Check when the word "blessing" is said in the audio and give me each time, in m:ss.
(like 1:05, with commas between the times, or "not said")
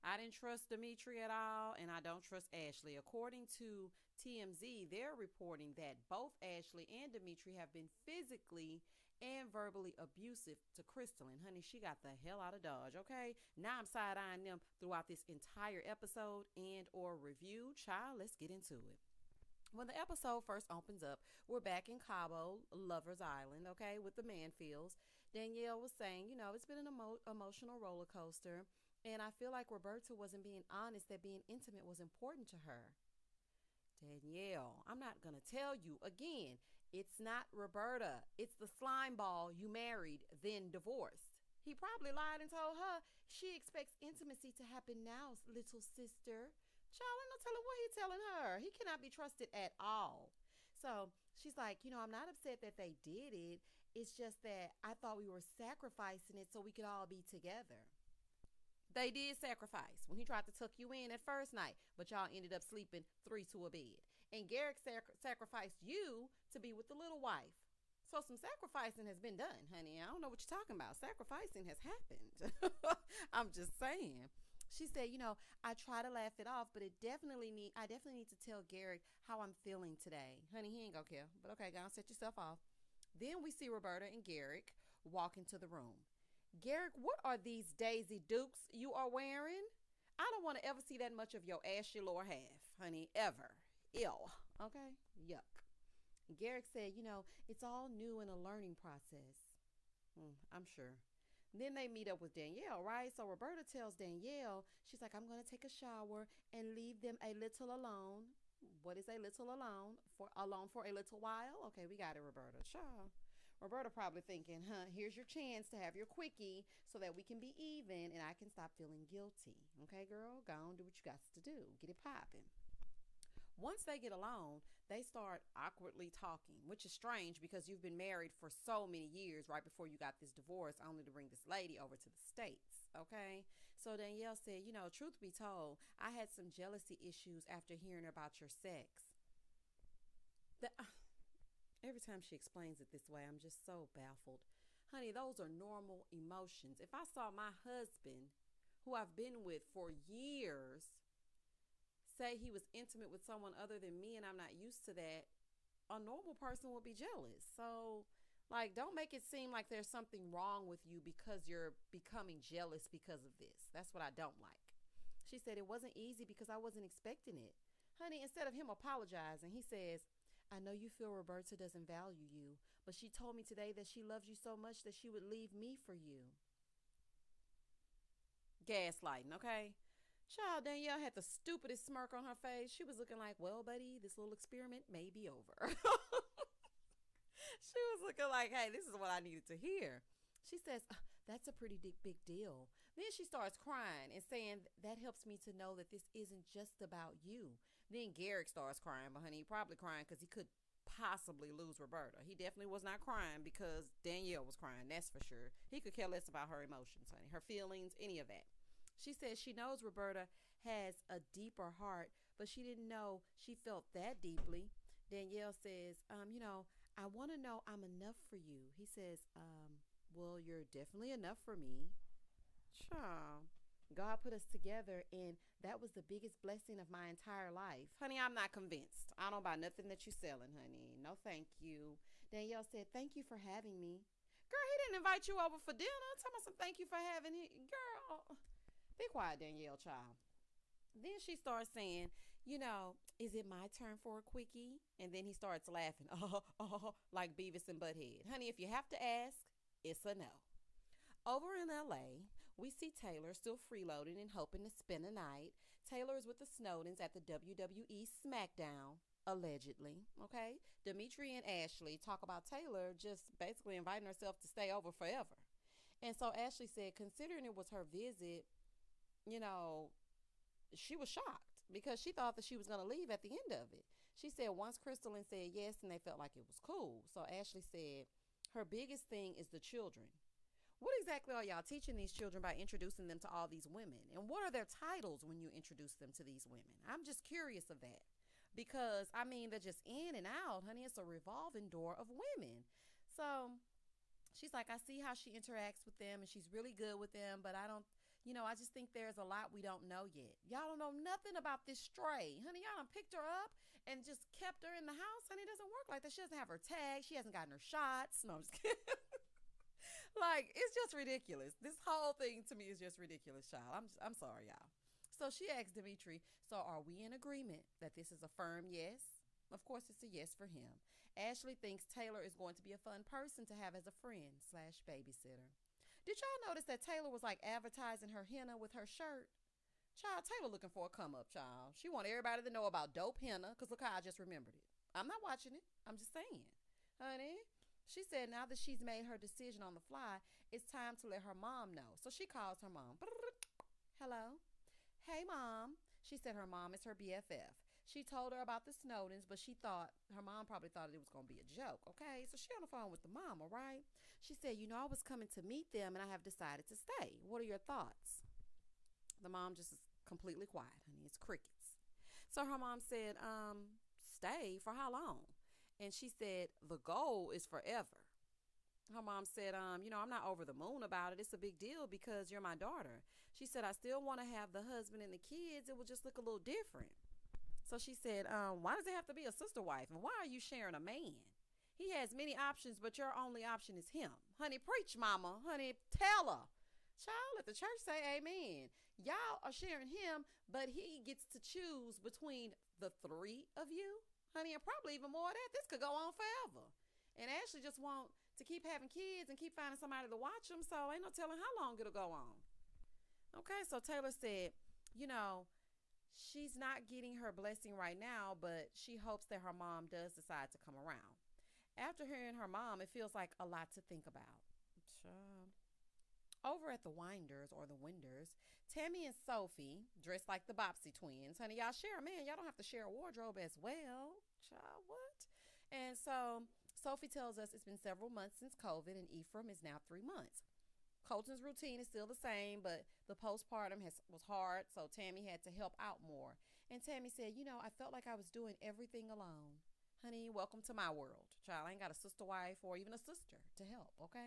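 3:46, 6:47.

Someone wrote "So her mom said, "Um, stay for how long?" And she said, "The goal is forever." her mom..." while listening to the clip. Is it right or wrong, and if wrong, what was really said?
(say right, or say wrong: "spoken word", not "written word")
right.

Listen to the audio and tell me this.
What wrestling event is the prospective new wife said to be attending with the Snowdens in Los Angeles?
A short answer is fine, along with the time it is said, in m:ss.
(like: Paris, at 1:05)
WWE SmackDown, at 4:17.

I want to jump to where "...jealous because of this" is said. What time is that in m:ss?
2:42.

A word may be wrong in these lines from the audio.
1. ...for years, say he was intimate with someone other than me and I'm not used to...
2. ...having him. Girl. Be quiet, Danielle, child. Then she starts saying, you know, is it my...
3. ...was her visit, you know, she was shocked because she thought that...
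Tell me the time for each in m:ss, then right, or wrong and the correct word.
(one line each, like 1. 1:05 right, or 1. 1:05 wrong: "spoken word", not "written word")
1. 2:29 right
2. 3:56 right
3. 4:27 right.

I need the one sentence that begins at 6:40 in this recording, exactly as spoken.
So ain't no telling how long it'll go on.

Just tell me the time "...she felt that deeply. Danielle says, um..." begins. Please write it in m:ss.
3:33.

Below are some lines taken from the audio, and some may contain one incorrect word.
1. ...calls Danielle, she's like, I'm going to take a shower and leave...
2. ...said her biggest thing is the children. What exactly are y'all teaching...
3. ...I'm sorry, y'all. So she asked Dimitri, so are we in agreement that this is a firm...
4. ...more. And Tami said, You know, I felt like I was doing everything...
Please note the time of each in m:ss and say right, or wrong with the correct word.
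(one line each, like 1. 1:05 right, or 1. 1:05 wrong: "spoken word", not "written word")
1. 1:43 wrong: "tells", not "calls"
2. 4:37 right
3. 5:14 right
4. 7:16 right.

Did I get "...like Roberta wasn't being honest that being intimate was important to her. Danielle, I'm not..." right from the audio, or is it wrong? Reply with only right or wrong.
right.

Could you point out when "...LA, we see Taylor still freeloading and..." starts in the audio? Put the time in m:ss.
4:11.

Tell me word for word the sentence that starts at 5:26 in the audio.
Did y'all notice that Taylor was like advertising her henna with her shirt?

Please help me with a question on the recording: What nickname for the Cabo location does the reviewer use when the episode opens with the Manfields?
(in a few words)
Lover's Island.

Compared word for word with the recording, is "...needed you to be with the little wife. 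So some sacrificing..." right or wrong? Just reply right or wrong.
wrong.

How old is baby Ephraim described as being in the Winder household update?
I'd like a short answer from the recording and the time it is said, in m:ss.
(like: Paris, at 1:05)
3 months, at 7:09.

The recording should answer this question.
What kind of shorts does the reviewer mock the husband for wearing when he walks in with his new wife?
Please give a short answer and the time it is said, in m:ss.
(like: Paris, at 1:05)
Daisy Dukes, at 1:27.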